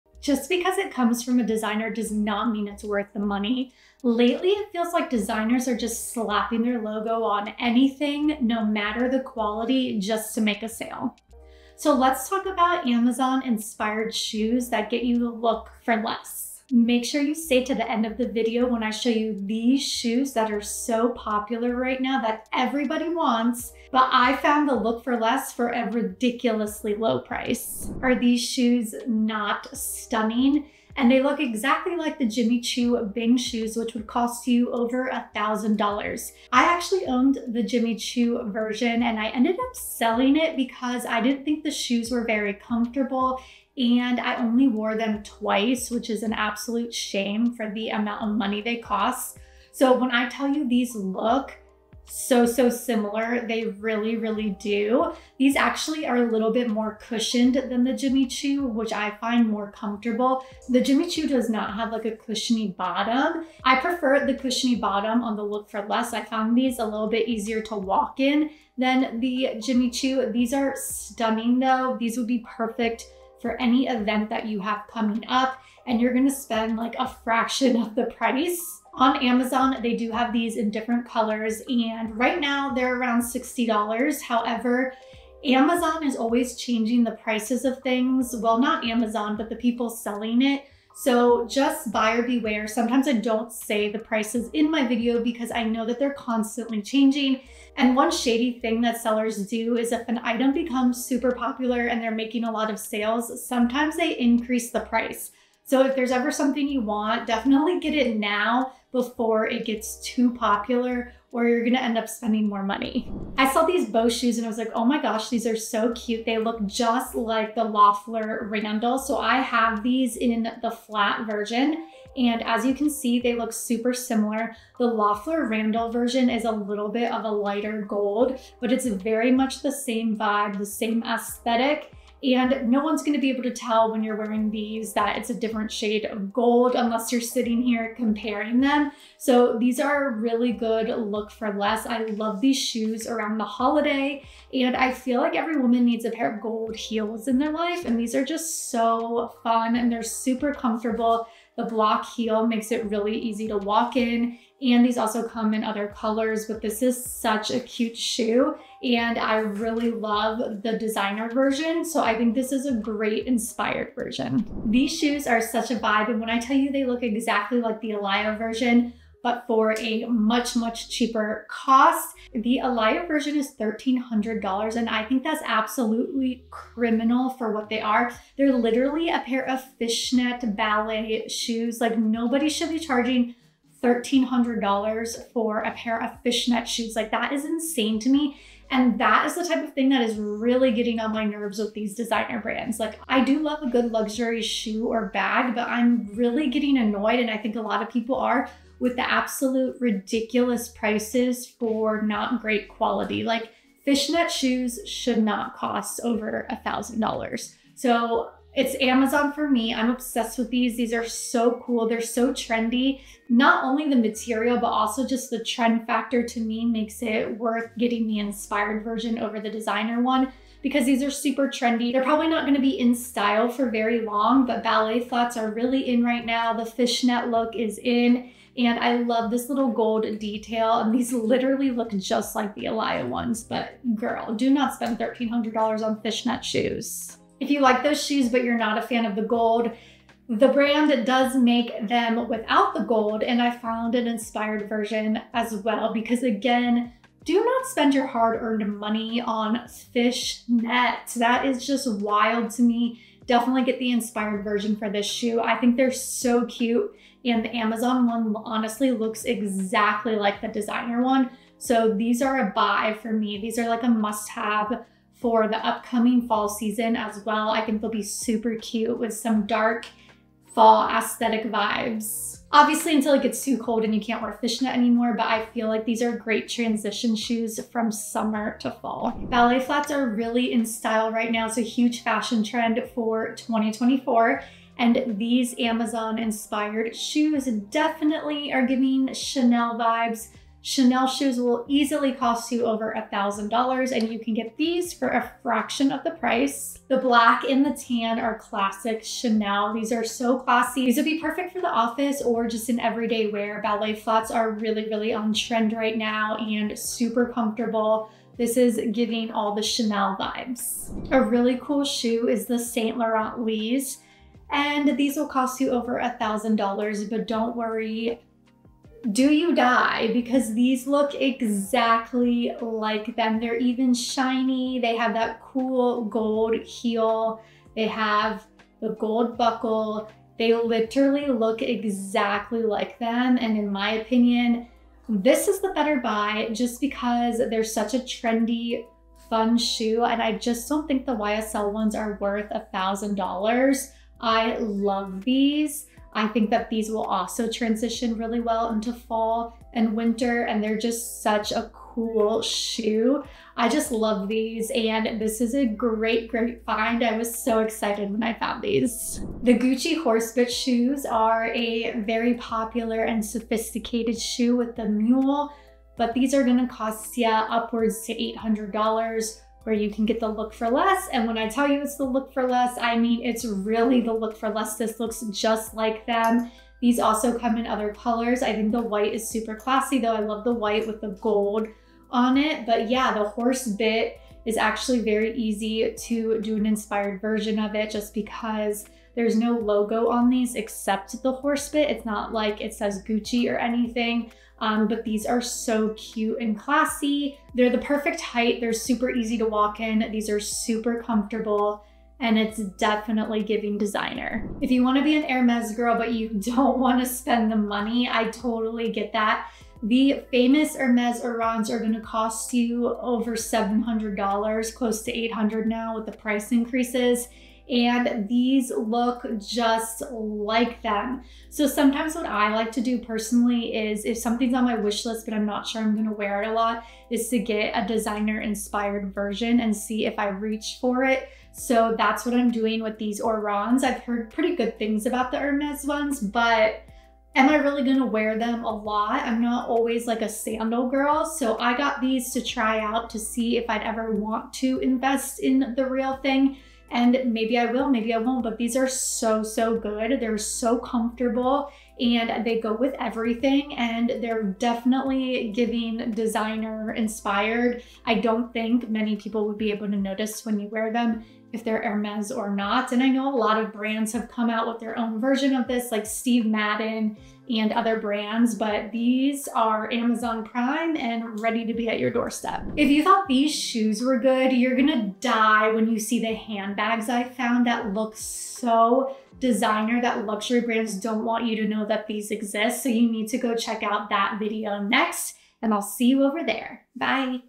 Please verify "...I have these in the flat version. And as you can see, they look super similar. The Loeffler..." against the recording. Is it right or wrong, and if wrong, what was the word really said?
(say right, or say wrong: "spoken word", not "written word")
right.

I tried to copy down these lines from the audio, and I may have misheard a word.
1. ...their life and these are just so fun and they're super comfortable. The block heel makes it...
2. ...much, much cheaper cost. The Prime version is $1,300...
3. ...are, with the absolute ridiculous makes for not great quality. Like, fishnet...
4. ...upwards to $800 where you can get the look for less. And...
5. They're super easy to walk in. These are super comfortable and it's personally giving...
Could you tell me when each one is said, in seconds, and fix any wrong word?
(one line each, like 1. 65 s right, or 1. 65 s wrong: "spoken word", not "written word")
1. 147 s right
2. 170 s wrong: "Alaia", not "Prime"
3. 198 s wrong: "prices", not "makes"
4. 367 s right
5. 398 s wrong: "definitely", not "personally".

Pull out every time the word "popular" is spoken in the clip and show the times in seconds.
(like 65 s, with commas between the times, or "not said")
21 s, 101 s, 110 s, 362 s.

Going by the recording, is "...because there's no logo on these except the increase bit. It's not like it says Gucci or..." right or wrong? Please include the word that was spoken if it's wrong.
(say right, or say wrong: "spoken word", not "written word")
wrong: "horse", not "increase".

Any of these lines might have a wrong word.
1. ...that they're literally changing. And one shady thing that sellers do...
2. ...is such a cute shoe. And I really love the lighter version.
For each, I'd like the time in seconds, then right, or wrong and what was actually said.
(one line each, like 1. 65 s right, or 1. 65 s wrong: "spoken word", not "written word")
1. 95 s wrong: "constantly", not "literally"
2. 156 s wrong: "designer", not "lighter".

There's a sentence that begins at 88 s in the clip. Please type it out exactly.
Well, not Amazon, but the people selling it.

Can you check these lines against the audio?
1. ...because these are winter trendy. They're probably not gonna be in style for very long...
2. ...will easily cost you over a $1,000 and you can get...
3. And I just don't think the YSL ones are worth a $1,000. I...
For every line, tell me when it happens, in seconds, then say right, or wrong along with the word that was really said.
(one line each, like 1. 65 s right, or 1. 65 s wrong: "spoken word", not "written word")
1. 220 s wrong: "super", not "winter"
2. 291 s right
3. 340 s right.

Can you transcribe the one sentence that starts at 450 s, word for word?
They're so comfortable and they go with everything and they're definitely giving designer inspired.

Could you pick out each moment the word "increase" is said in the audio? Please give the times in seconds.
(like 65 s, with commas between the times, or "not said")
104 s, 416 s.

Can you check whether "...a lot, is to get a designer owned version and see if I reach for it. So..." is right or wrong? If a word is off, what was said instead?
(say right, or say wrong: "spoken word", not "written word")
wrong: "inspired", not "owned".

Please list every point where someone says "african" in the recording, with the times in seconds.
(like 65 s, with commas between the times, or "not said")
not said.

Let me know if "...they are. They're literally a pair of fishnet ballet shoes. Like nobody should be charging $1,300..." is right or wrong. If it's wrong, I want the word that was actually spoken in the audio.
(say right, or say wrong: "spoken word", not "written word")
right.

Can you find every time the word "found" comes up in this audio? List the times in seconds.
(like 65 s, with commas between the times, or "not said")
24 s, 66 s, 243 s, 358 s, 477 s.